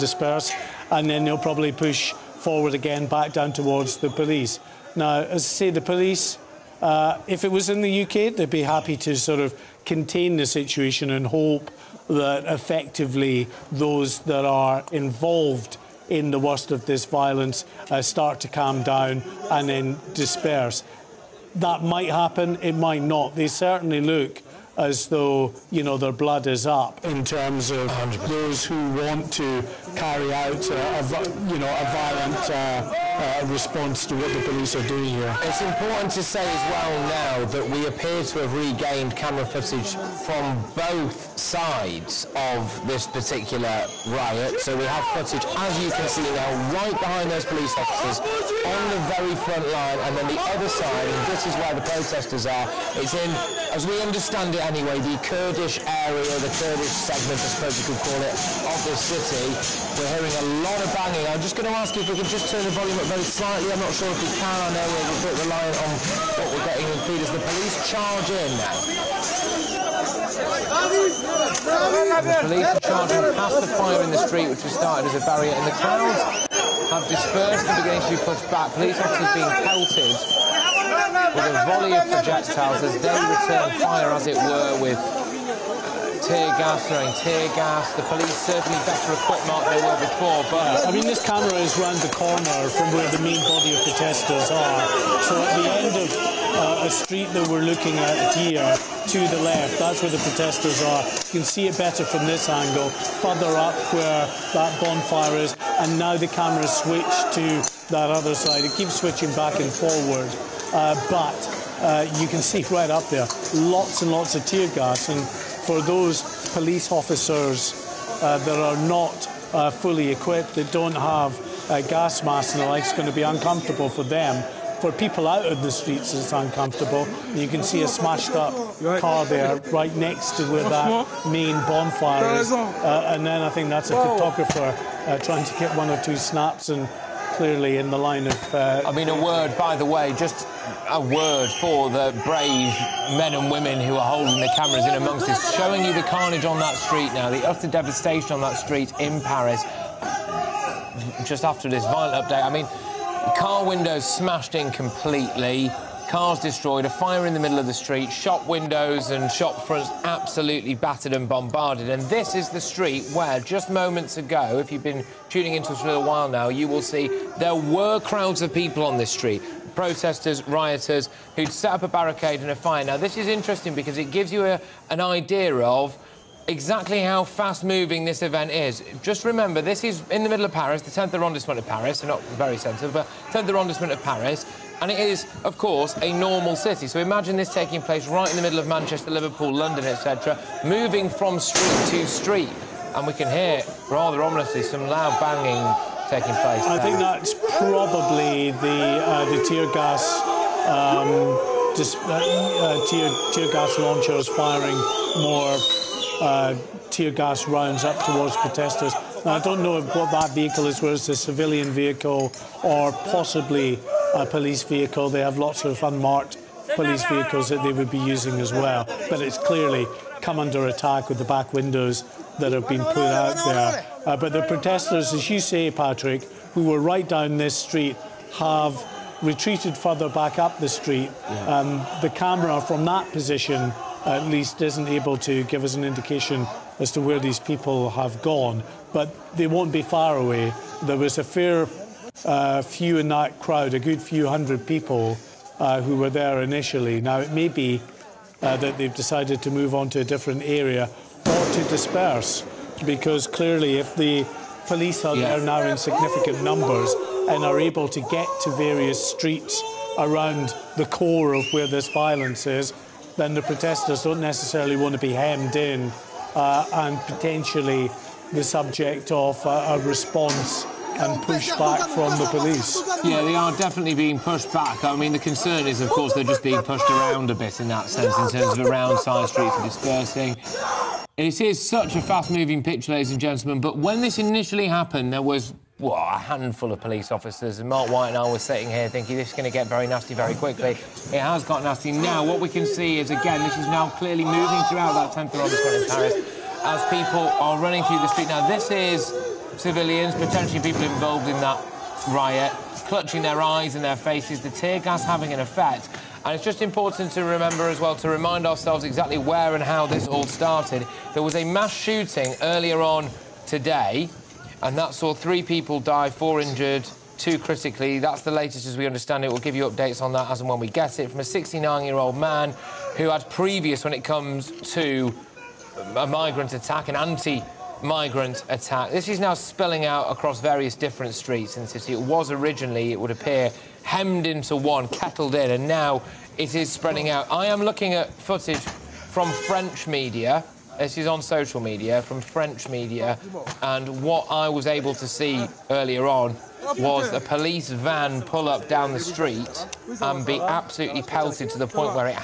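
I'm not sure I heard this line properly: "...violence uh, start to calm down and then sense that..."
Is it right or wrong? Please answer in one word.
wrong.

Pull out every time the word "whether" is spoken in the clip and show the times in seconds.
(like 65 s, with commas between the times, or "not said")
210 s.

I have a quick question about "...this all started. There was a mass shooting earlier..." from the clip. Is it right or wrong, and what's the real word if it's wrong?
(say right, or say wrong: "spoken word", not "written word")
right.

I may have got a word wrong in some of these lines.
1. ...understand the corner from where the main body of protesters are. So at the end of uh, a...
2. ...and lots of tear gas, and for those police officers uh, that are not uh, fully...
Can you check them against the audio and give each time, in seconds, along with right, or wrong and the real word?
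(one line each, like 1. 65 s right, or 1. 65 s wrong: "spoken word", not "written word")
1. 91 s wrong: "round", not "understand"
2. 114 s right.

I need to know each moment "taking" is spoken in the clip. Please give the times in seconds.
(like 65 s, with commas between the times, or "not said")
187 s, 196 s.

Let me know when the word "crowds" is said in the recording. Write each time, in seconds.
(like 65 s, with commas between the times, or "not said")
75 s, 167 s, 243 s.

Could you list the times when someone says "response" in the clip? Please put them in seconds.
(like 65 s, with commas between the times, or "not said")
33 s, 269 s.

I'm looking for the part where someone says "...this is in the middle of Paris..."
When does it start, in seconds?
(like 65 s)
179 s.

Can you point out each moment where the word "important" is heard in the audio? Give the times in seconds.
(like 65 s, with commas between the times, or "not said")
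35 s, 306 s.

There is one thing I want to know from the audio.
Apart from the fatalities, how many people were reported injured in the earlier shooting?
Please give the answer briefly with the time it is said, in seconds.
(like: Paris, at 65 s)
4, at 316 s.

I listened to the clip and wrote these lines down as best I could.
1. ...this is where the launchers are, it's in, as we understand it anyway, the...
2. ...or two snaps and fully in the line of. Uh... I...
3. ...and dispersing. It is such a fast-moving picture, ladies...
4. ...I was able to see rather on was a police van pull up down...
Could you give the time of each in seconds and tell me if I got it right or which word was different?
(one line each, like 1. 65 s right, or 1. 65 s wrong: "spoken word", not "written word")
1. 51 s wrong: "protesters", not "launchers"
2. 135 s wrong: "clearly", not "fully"
3. 279 s right
4. 344 s wrong: "earlier", not "rather".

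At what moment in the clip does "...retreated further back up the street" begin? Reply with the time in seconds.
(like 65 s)
229 s.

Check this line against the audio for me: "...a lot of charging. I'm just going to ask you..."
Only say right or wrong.
wrong.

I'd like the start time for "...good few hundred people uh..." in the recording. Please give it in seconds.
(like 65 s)
243 s.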